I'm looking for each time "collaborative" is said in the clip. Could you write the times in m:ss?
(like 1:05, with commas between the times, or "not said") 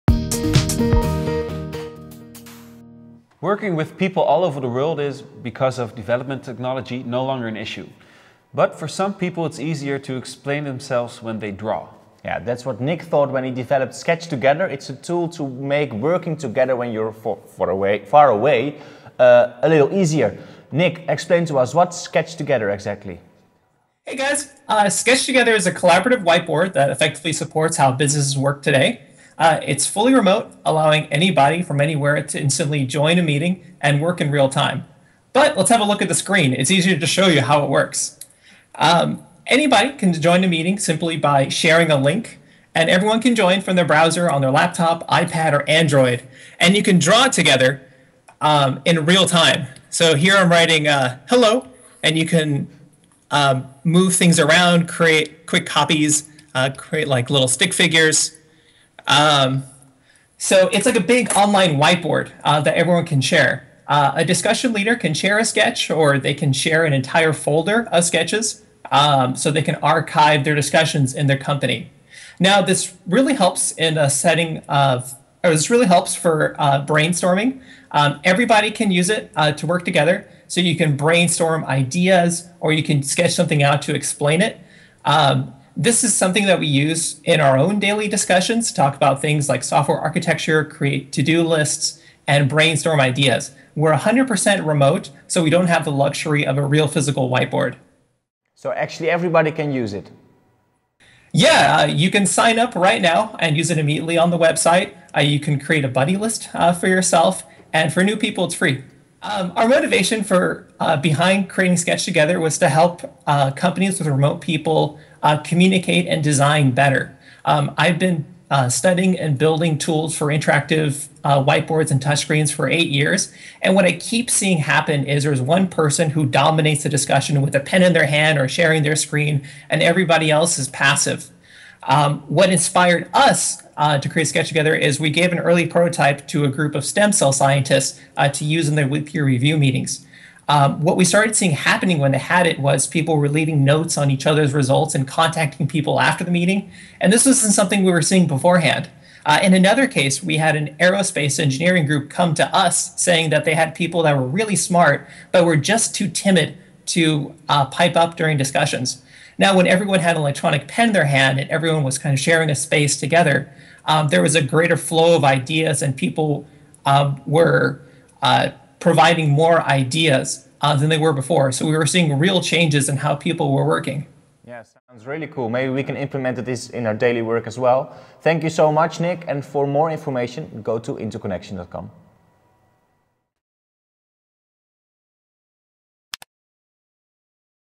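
0:25.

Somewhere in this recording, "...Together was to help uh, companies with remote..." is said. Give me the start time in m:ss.
1:52.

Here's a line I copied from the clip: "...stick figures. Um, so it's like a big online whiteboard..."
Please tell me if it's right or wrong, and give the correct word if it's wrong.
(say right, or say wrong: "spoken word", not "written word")
right.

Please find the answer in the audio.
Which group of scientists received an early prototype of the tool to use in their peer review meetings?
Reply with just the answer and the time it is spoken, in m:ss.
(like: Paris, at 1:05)
stem cell scientists, at 2:16.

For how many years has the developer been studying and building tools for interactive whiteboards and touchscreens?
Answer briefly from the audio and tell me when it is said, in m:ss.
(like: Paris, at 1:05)
8, at 2:02.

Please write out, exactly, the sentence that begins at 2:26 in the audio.
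And this wasn't something we were seeing beforehand.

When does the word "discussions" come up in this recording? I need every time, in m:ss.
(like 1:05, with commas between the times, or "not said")
1:04, 1:10, 1:28, 2:06, 2:38.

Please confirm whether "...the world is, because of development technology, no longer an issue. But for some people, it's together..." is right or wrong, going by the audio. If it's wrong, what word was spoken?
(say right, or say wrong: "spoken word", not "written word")
wrong: "easier", not "together".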